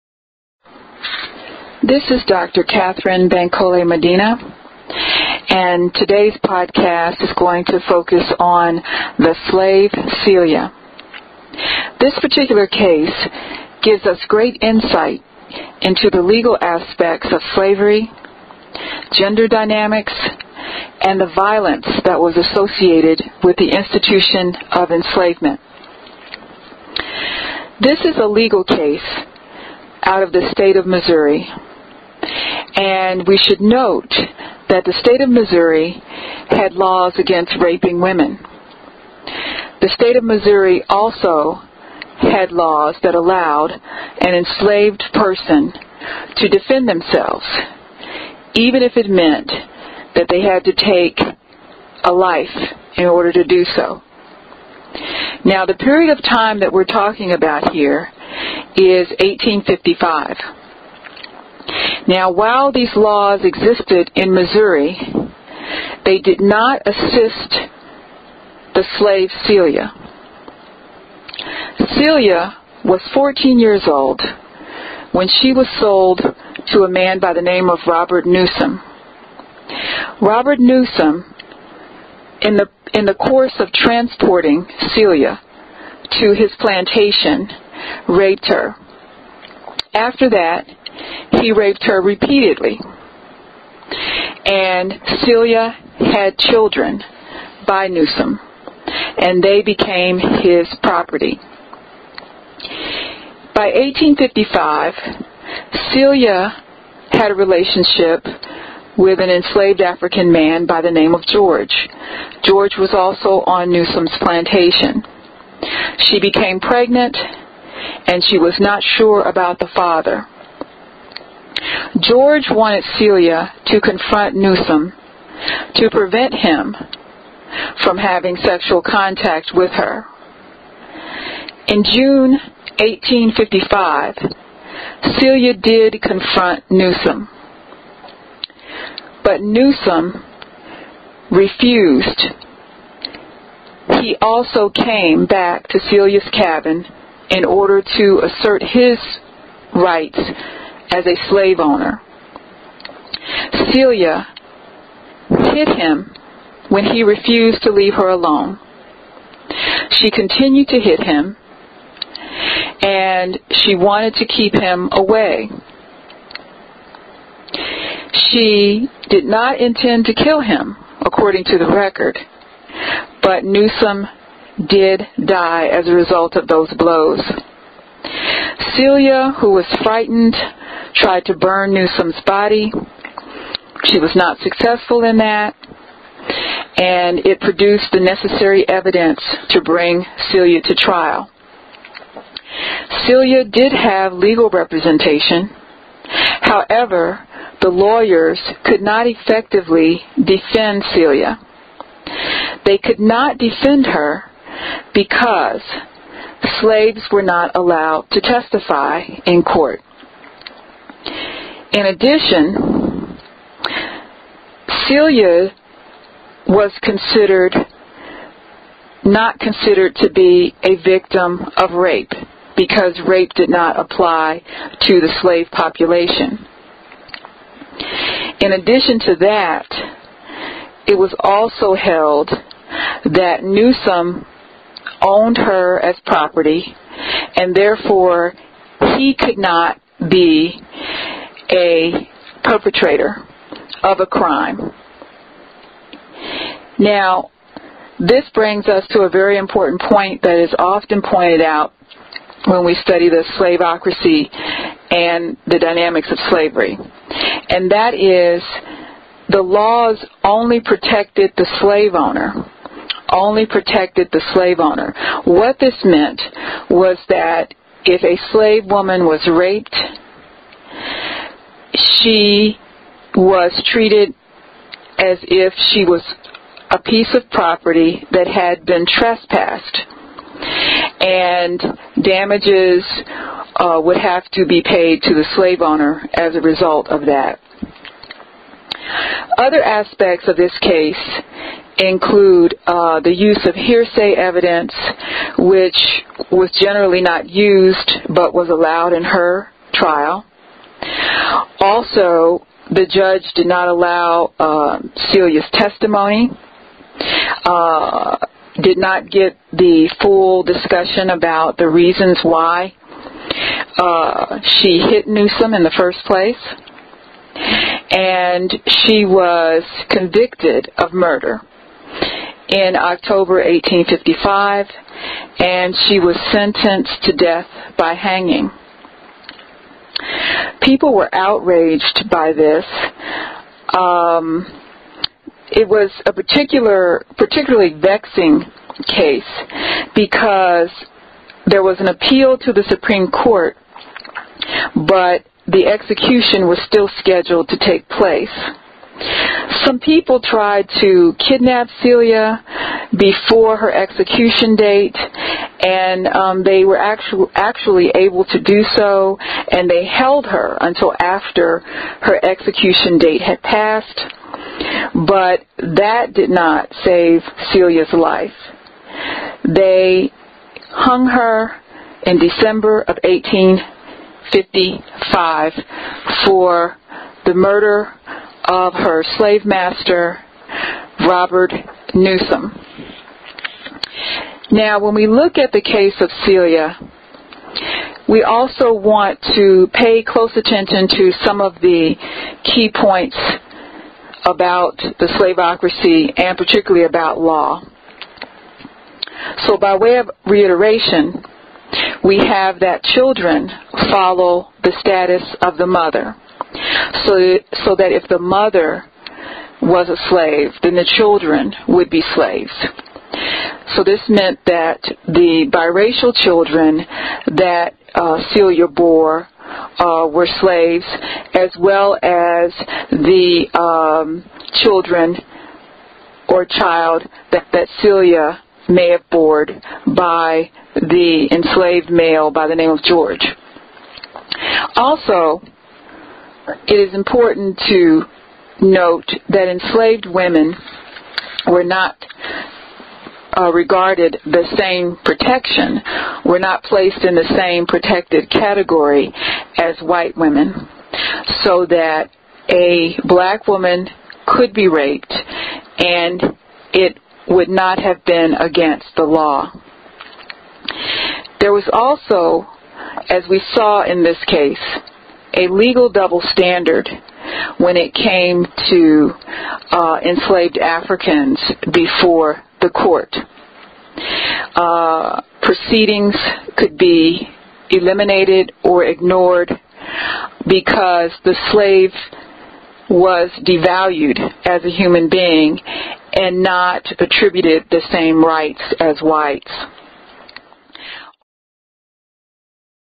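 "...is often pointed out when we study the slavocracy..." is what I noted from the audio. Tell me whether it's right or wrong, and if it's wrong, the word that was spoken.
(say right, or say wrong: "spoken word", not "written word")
right.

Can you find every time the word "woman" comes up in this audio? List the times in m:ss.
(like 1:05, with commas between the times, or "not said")
4:28, 7:33.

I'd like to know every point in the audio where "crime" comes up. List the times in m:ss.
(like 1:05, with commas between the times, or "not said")
4:04.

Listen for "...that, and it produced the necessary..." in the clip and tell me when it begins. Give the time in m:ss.
3:05.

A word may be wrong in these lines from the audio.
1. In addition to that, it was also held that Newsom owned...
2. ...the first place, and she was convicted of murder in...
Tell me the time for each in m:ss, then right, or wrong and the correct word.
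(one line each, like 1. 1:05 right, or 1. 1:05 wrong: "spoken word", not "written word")
1. 3:48 right
2. 5:15 right.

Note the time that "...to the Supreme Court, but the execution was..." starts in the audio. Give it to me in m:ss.
5:42.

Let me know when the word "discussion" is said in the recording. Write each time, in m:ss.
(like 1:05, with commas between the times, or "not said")
5:10.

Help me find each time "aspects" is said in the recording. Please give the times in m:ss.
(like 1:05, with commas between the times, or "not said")
0:16, 4:49.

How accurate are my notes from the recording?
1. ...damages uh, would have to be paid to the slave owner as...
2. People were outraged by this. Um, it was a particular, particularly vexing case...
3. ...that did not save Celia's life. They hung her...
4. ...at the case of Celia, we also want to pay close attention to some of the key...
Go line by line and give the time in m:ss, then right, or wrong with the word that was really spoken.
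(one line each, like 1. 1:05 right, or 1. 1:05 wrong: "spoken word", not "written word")
1. 4:42 right
2. 5:30 right
3. 6:05 right
4. 6:25 right.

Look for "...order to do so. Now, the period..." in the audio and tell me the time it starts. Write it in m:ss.
0:53.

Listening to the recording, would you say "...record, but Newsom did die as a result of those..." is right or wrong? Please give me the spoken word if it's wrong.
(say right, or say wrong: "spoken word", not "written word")
right.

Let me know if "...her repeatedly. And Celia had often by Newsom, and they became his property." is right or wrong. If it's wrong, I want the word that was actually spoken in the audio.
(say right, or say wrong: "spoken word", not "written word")
wrong: "children", not "often".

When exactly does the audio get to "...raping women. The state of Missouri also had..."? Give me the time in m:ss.
0:37.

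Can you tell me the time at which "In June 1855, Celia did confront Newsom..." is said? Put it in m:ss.
2:11.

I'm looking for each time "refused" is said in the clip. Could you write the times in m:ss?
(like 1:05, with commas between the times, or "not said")
2:21, 2:37.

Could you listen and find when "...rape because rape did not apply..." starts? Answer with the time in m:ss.
3:41.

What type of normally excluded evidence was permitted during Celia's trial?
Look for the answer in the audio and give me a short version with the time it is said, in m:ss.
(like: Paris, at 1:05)
Hearsay evidence, at 4:53.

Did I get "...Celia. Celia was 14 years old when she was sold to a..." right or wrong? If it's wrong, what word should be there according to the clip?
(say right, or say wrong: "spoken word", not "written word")
right.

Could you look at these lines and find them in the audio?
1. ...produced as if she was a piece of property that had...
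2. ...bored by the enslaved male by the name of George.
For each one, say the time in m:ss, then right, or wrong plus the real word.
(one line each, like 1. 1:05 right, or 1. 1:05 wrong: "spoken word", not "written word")
1. 4:33 wrong: "treated", not "produced"
2. 7:09 right.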